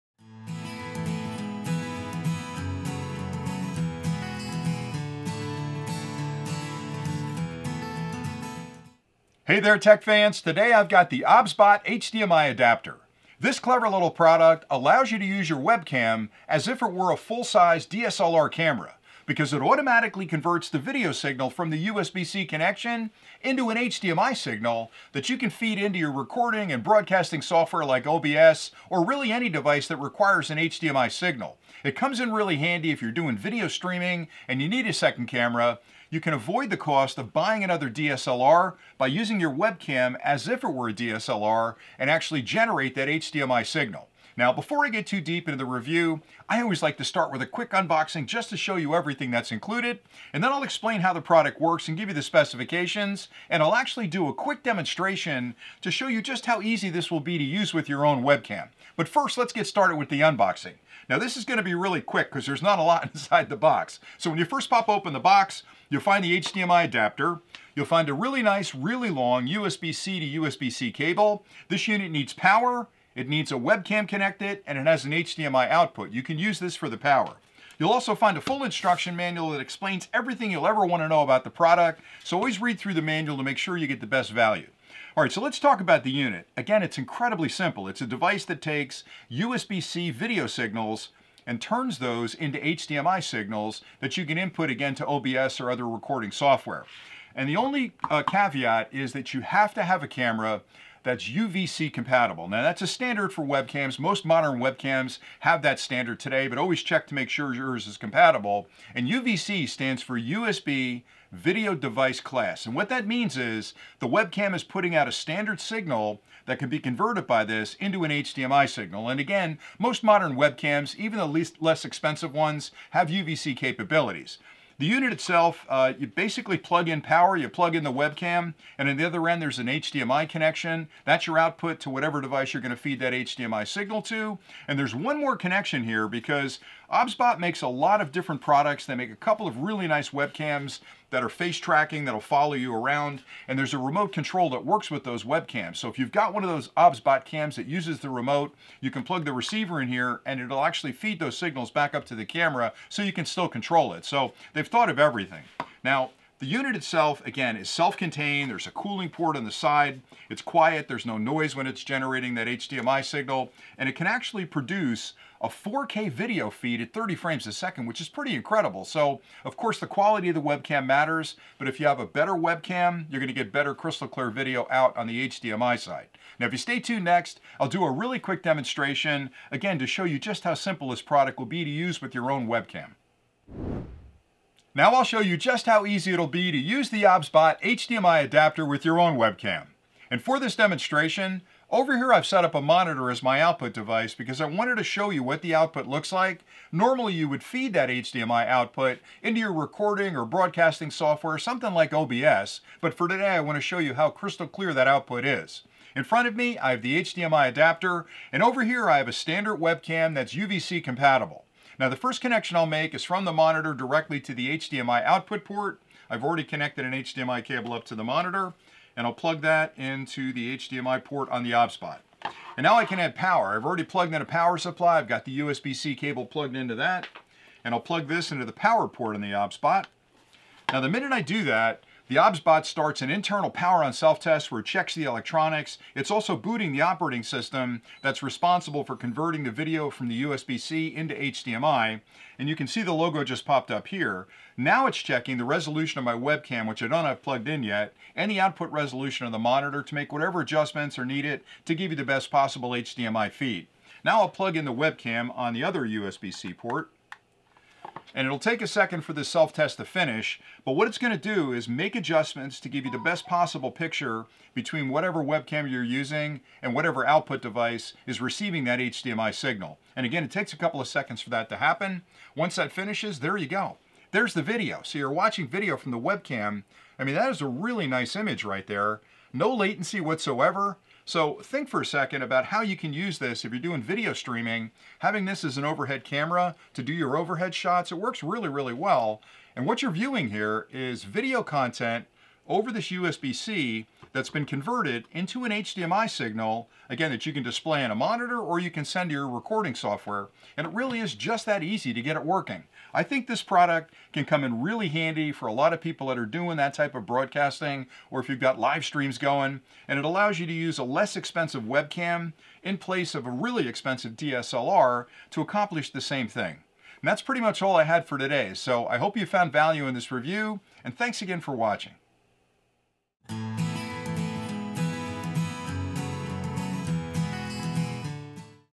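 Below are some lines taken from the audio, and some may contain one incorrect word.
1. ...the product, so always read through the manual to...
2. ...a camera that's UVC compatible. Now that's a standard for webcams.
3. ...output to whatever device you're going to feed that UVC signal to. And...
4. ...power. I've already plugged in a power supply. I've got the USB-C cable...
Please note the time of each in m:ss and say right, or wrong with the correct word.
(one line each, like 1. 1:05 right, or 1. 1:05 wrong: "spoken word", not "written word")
1. 1:21 right
2. 1:40 right
3. 2:11 wrong: "HDMI", not "UVC"
4. 3:43 right.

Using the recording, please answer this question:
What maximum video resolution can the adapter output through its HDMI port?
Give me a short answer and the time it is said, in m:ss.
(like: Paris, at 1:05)
4K, at 2:45.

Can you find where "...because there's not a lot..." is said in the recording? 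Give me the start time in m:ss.
1:02.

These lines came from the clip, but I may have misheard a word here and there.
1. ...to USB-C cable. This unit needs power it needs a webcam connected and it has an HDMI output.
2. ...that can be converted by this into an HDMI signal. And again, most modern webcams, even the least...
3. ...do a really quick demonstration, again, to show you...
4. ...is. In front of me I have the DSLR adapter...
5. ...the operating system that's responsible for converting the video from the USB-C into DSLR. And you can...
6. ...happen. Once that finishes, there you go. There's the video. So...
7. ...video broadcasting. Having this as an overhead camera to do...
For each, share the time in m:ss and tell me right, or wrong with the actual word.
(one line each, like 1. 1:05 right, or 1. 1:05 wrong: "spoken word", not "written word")
1. 1:10 right
2. 1:56 right
3. 2:57 right
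4. 3:25 wrong: "HDMI", not "DSLR"
5. 3:56 wrong: "HDMI", not "DSLR"
6. 4:31 right
7. 4:43 wrong: "streaming", not "broadcasting".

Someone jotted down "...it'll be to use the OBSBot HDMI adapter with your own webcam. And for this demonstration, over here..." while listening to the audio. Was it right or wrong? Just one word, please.
right.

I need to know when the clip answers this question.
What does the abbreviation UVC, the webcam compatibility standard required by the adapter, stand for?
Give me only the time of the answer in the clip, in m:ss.
1:50.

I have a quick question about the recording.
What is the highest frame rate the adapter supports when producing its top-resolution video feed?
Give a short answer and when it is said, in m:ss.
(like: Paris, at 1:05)
30 frames per second, at 2:46.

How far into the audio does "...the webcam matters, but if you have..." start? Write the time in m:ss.
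2:50.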